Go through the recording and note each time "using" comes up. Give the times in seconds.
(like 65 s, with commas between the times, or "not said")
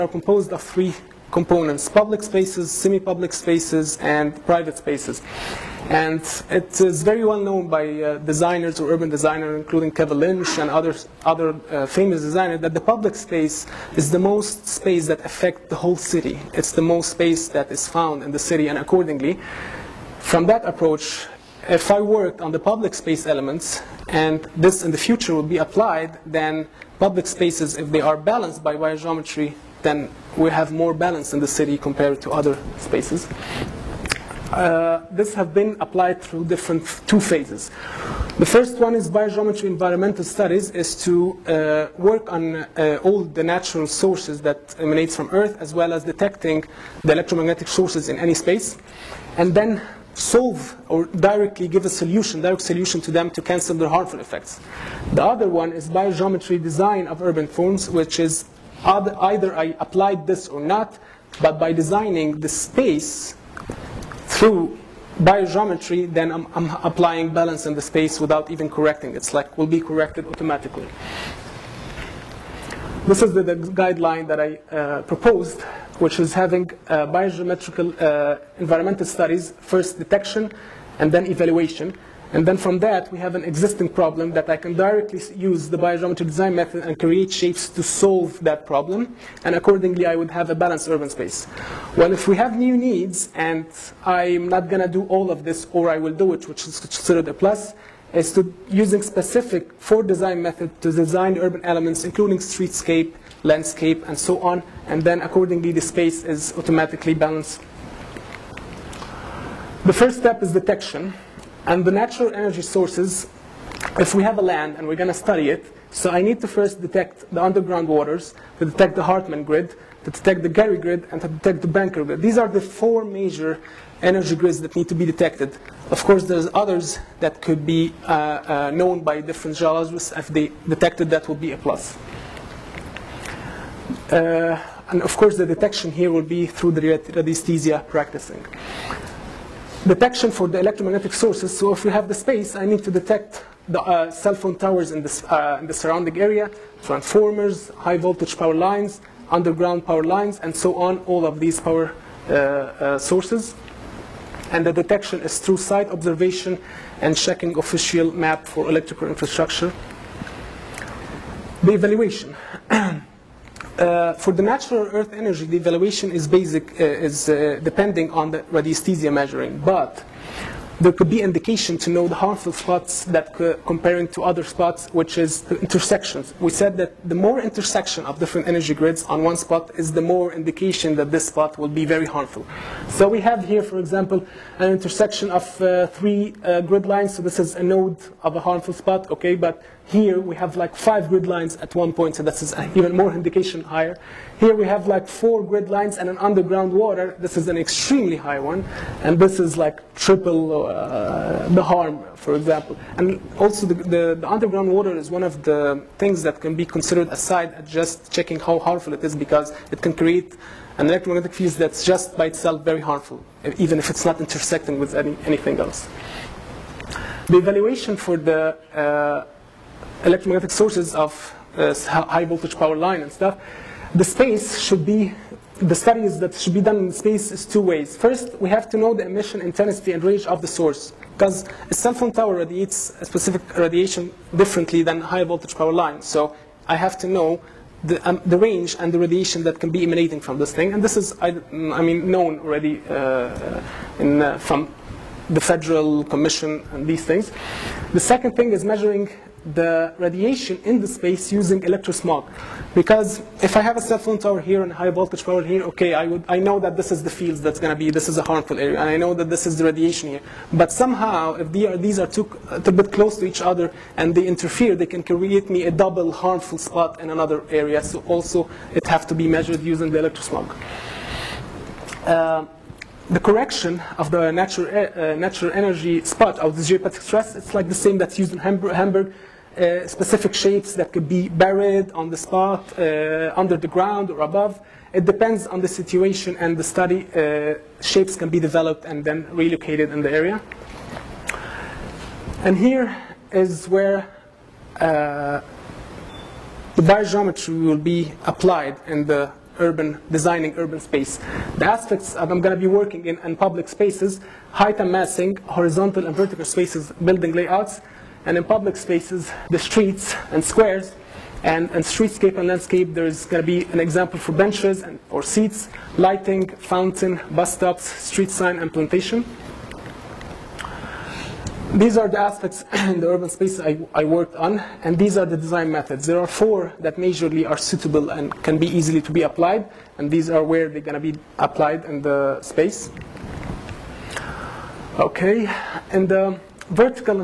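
98 s, 251 s, 269 s.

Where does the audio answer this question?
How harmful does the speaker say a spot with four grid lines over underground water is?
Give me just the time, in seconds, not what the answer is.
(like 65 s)
199 s.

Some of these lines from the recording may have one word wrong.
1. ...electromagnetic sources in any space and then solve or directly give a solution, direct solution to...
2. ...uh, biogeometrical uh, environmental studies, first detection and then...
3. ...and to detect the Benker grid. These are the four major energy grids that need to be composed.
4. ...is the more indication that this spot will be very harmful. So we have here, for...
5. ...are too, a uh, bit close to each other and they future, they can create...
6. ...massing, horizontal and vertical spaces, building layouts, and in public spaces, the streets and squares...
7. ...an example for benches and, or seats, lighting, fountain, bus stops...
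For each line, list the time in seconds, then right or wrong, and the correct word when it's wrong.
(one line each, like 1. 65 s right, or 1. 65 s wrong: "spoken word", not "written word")
1. 47 s right
2. 76 s right
3. 121 s wrong: "detected", not "composed"
4. 179 s right
5. 261 s wrong: "interfere", not "future"
6. 304 s right
7. 313 s right.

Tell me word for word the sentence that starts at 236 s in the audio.
So I have to know the, um, the range and the radiation that can be emanating from this thing.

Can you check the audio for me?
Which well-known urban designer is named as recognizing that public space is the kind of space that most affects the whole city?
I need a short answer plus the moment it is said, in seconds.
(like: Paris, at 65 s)
Kevin Lynch, at 9 s.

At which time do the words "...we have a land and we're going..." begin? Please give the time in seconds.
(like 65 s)
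114 s.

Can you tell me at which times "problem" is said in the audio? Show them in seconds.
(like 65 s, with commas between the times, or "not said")
83 s, 88 s.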